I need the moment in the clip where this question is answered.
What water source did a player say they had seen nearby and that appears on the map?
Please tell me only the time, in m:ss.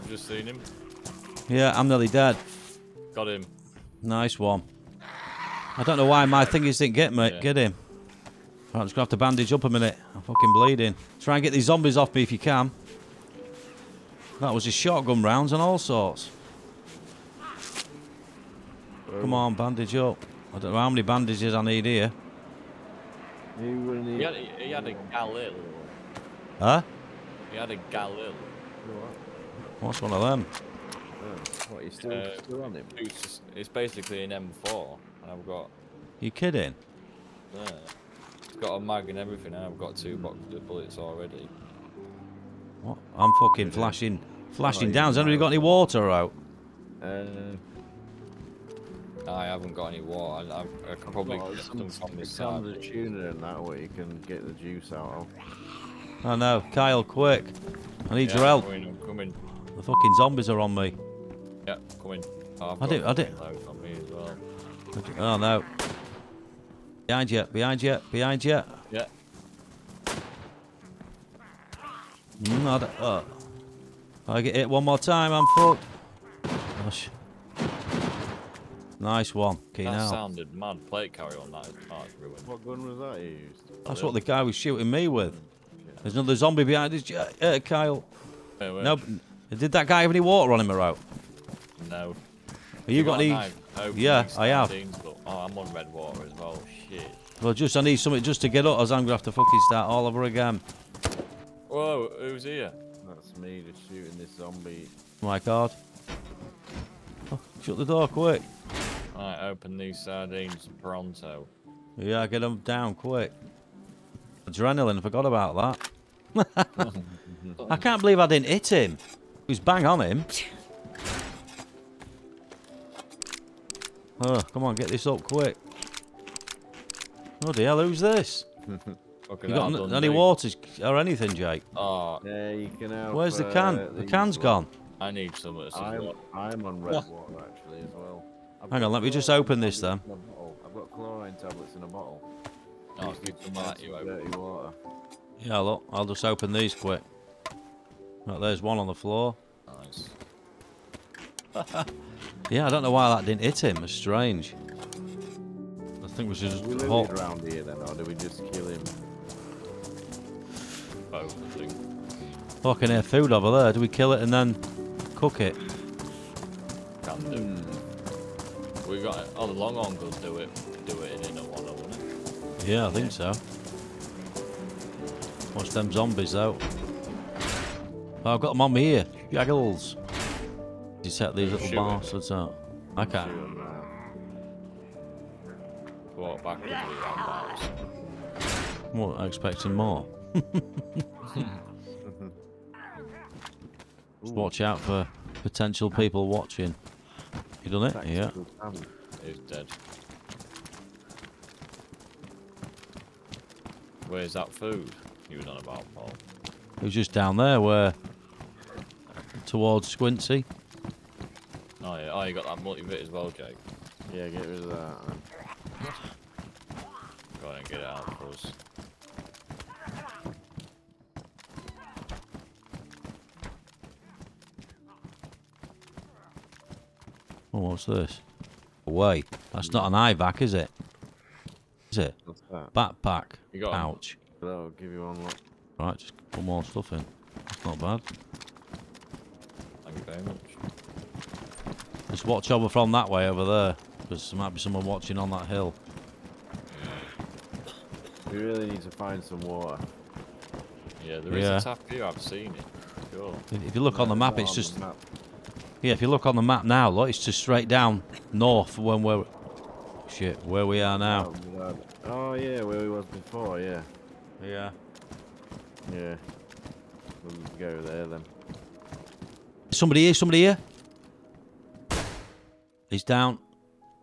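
4:11.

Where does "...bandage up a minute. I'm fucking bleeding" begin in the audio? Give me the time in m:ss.
0:09.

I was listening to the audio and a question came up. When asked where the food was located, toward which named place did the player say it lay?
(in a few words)
Squincy.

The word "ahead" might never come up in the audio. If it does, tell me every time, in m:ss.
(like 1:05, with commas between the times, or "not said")
3:37.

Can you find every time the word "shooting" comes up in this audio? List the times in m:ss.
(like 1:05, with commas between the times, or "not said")
1:24, 1:43.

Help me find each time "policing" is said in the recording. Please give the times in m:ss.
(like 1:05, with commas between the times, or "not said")
not said.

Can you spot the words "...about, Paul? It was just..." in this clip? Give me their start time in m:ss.
3:25.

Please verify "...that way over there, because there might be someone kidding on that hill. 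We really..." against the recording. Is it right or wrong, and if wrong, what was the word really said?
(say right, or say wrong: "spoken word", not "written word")
wrong: "watching", not "kidding".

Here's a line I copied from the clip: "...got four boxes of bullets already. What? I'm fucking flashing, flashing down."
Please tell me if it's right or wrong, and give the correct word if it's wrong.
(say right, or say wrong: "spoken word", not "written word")
wrong: "two", not "four".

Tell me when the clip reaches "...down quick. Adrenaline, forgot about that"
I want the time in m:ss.
1:52.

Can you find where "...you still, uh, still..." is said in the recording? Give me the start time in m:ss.
0:31.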